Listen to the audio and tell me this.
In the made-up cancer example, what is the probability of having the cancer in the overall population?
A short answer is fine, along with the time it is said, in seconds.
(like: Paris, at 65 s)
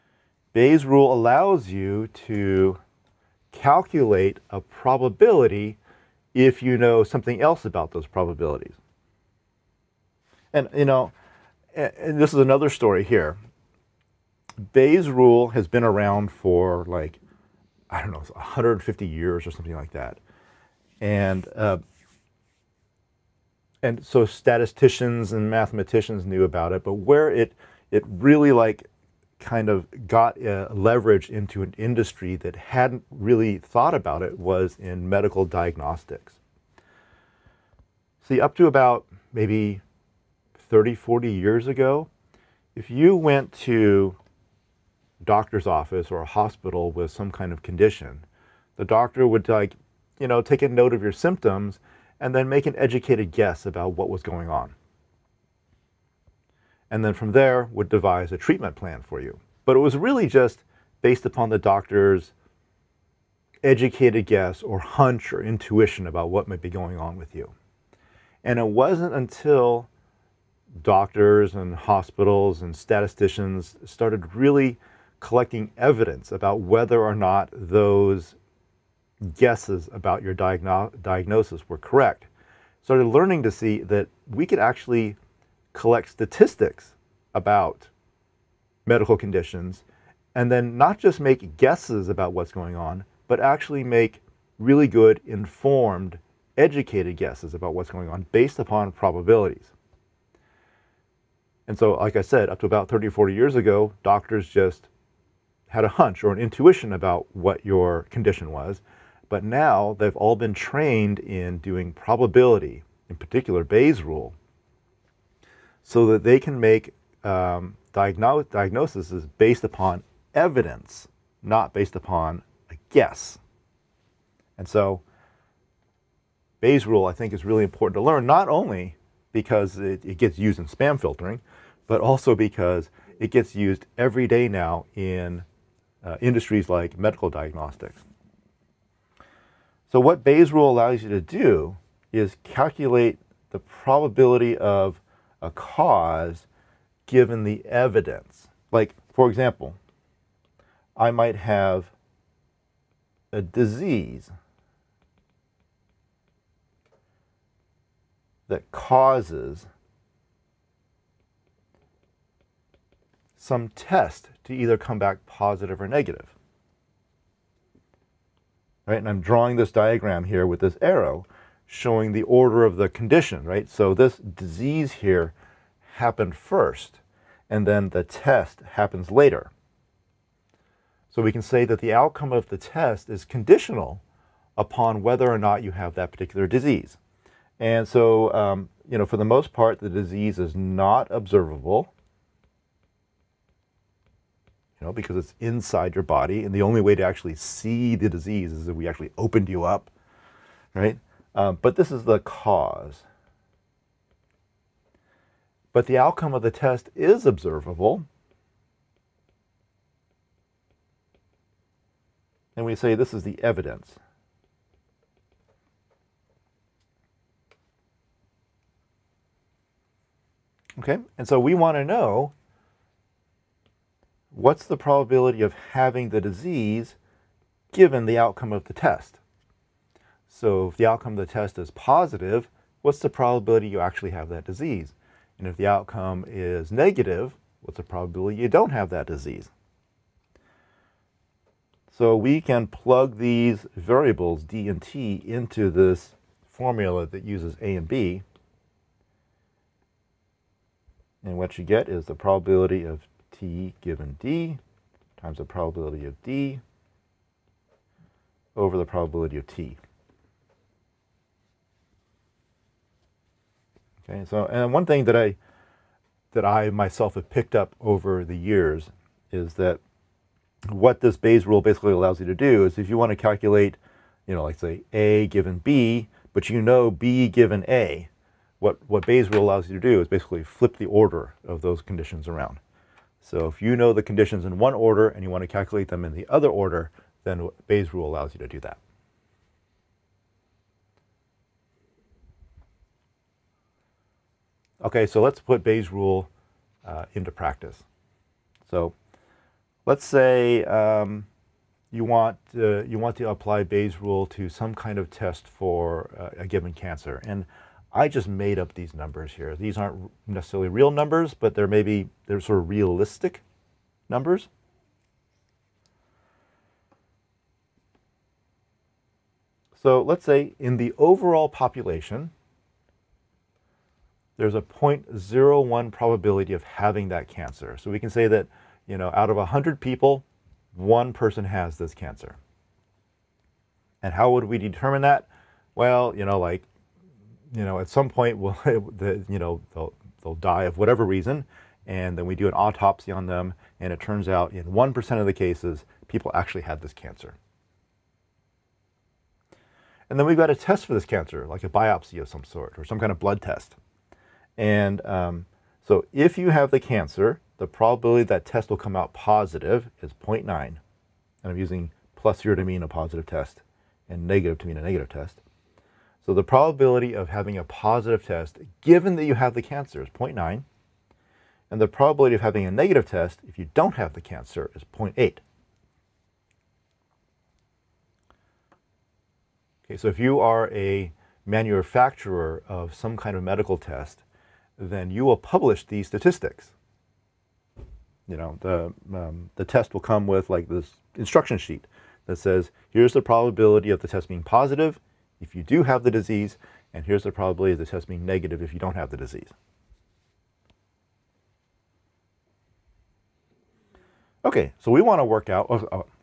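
0.01, at 324 s.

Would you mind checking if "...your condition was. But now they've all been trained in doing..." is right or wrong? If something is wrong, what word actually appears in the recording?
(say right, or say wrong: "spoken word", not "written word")
right.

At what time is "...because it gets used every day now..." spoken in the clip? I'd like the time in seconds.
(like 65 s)
132 s.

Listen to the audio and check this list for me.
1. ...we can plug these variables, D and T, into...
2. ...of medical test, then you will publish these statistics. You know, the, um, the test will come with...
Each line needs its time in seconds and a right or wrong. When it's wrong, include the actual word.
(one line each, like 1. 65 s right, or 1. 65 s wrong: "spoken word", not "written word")
1. 242 s right
2. 383 s right.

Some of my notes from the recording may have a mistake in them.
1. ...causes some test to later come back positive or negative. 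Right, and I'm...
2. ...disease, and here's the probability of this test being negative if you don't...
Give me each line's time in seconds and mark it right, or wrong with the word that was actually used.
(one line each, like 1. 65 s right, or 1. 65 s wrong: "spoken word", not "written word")
1. 158 s wrong: "either", not "later"
2. 396 s right.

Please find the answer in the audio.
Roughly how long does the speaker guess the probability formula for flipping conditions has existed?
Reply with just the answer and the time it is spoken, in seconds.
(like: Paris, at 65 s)
150 years, at 18 s.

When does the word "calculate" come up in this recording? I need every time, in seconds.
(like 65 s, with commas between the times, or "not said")
3 s, 142 s, 273 s, 285 s.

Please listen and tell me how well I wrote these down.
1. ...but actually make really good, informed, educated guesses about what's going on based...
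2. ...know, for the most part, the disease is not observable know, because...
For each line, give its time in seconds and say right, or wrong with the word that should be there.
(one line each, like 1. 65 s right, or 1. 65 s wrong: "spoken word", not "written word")
1. 93 s right
2. 188 s right.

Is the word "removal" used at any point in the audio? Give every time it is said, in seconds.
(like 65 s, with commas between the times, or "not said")
not said.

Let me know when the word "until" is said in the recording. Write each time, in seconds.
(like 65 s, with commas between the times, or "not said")
69 s.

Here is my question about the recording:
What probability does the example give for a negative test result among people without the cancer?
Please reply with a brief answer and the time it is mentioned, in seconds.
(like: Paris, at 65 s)
0.8, at 374 s.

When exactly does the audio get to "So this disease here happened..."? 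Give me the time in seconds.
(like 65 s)
173 s.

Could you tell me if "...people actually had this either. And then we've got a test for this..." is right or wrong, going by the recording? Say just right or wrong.
wrong.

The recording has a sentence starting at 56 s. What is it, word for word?
And then from there would devise a treatment plan for you.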